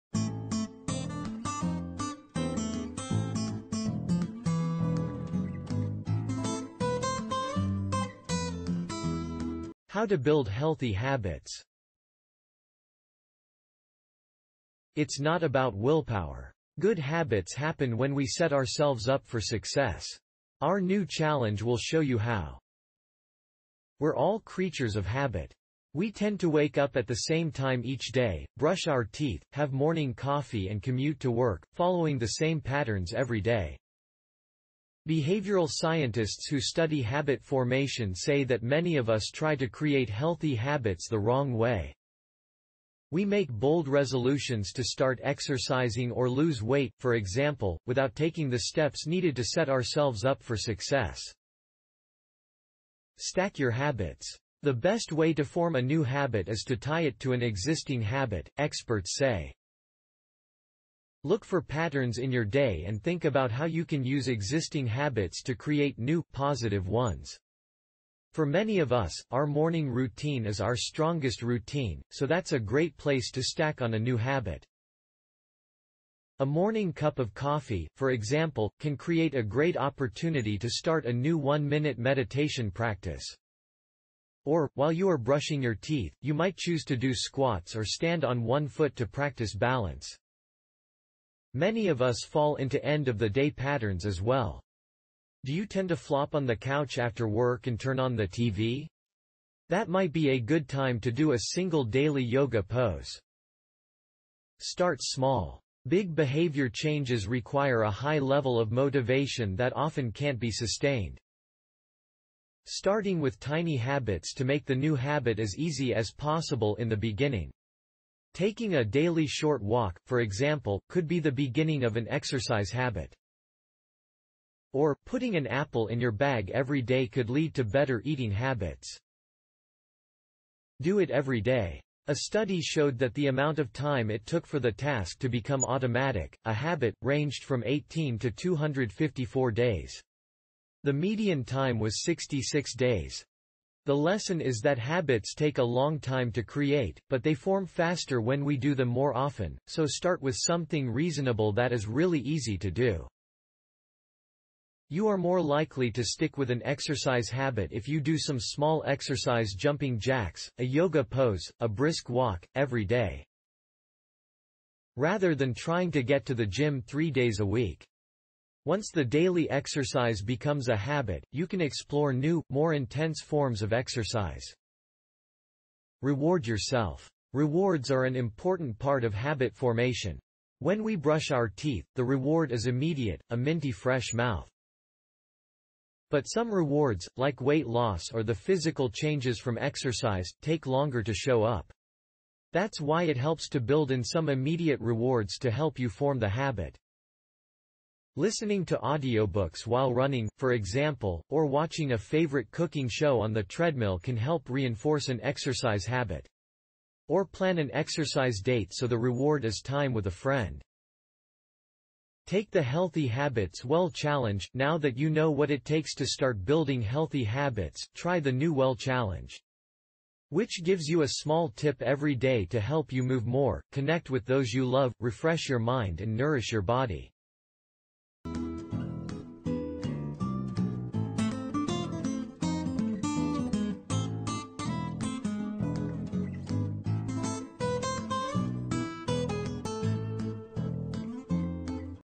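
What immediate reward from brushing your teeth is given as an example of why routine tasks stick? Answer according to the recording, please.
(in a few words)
a minty fresh mouth.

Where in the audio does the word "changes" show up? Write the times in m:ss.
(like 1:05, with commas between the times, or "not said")
1:46, 3:08.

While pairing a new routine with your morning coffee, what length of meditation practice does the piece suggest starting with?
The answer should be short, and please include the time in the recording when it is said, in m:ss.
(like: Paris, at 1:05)
one-minute, at 1:21.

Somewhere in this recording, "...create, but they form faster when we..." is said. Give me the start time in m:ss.
2:26.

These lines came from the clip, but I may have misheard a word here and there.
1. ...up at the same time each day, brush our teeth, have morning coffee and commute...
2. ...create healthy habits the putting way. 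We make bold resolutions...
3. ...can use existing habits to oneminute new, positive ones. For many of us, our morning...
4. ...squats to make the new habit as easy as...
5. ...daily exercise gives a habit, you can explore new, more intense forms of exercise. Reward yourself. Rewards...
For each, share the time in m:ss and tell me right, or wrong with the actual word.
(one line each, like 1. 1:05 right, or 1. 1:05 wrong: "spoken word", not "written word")
1. 0:26 right
2. 0:39 wrong: "wrong", not "putting"
3. 1:03 wrong: "create", not "oneminute"
4. 1:53 wrong: "habits", not "squats"
5. 2:49 wrong: "becomes", not "gives".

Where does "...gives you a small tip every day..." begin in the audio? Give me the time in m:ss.
3:40.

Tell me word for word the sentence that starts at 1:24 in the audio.
Or, while you are brushing your teeth, you might choose to do squats or stand on one foot to practice balance.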